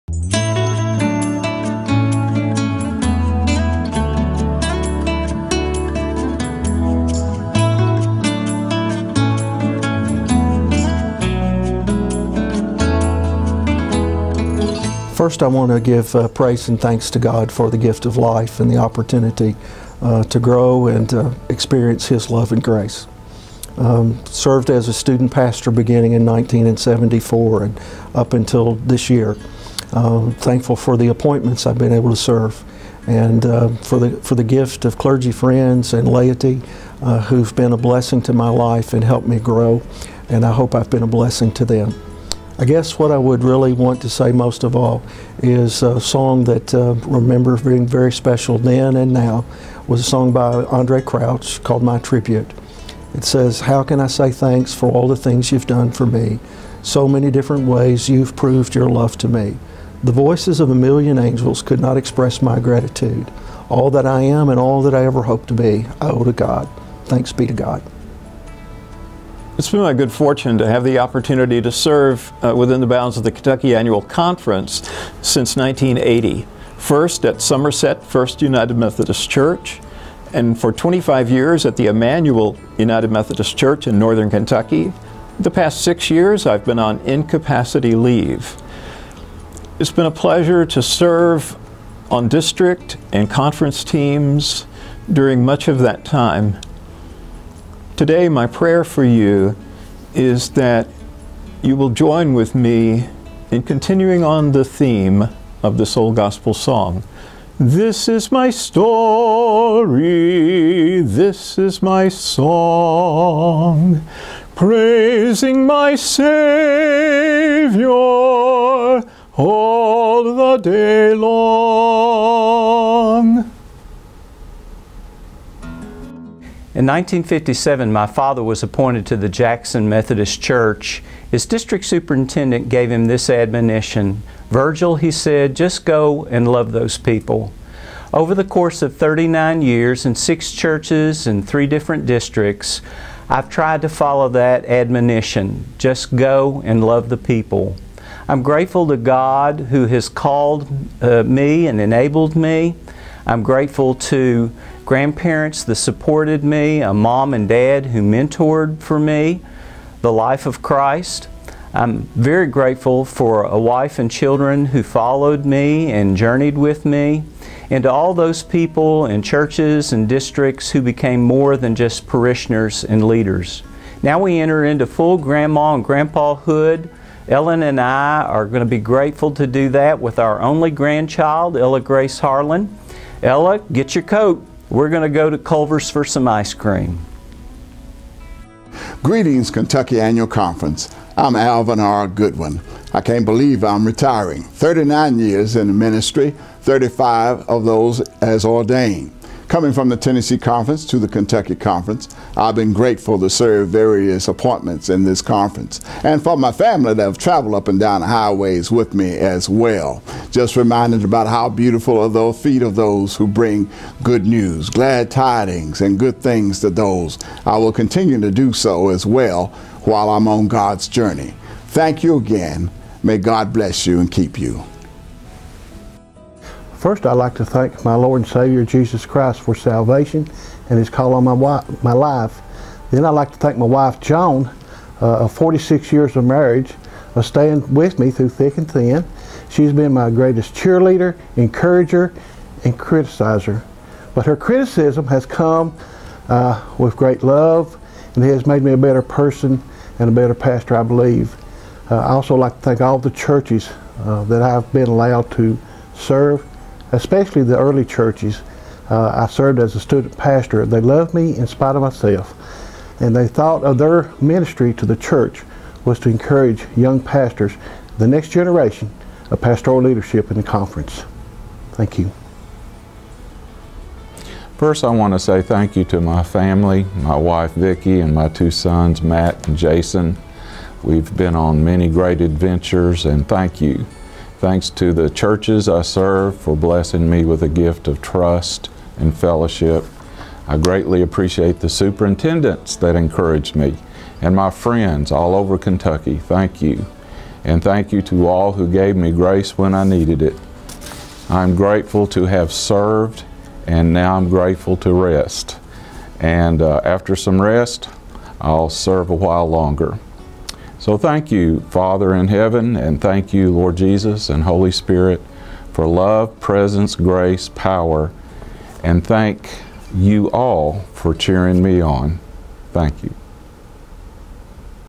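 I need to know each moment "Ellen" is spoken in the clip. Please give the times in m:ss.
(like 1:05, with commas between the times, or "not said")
2:57.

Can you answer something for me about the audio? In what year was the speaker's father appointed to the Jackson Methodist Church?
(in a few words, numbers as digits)
1957.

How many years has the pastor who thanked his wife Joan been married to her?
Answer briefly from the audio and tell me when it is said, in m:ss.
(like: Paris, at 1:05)
46, at 3:55.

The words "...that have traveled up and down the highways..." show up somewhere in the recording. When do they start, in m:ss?
3:26.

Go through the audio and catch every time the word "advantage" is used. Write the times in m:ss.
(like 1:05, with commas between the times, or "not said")
not said.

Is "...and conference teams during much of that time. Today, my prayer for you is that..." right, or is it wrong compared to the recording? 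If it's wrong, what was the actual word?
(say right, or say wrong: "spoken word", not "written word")
right.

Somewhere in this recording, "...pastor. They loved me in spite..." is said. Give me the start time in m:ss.
4:20.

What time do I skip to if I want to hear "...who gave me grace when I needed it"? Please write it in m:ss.
4:58.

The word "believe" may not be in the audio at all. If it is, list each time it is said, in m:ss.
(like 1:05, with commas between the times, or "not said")
3:13, 4:10.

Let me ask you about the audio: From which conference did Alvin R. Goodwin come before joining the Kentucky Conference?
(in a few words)
Tennessee Conference.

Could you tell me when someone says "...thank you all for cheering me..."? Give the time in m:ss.
5:19.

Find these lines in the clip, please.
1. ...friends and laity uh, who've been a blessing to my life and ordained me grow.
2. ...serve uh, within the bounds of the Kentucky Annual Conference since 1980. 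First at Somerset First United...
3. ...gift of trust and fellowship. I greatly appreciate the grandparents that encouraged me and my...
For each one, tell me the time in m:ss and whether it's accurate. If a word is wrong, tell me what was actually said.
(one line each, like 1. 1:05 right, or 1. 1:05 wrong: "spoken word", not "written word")
1. 0:35 wrong: "helped", not "ordained"
2. 1:11 right
3. 4:47 wrong: "superintendents", not "grandparents".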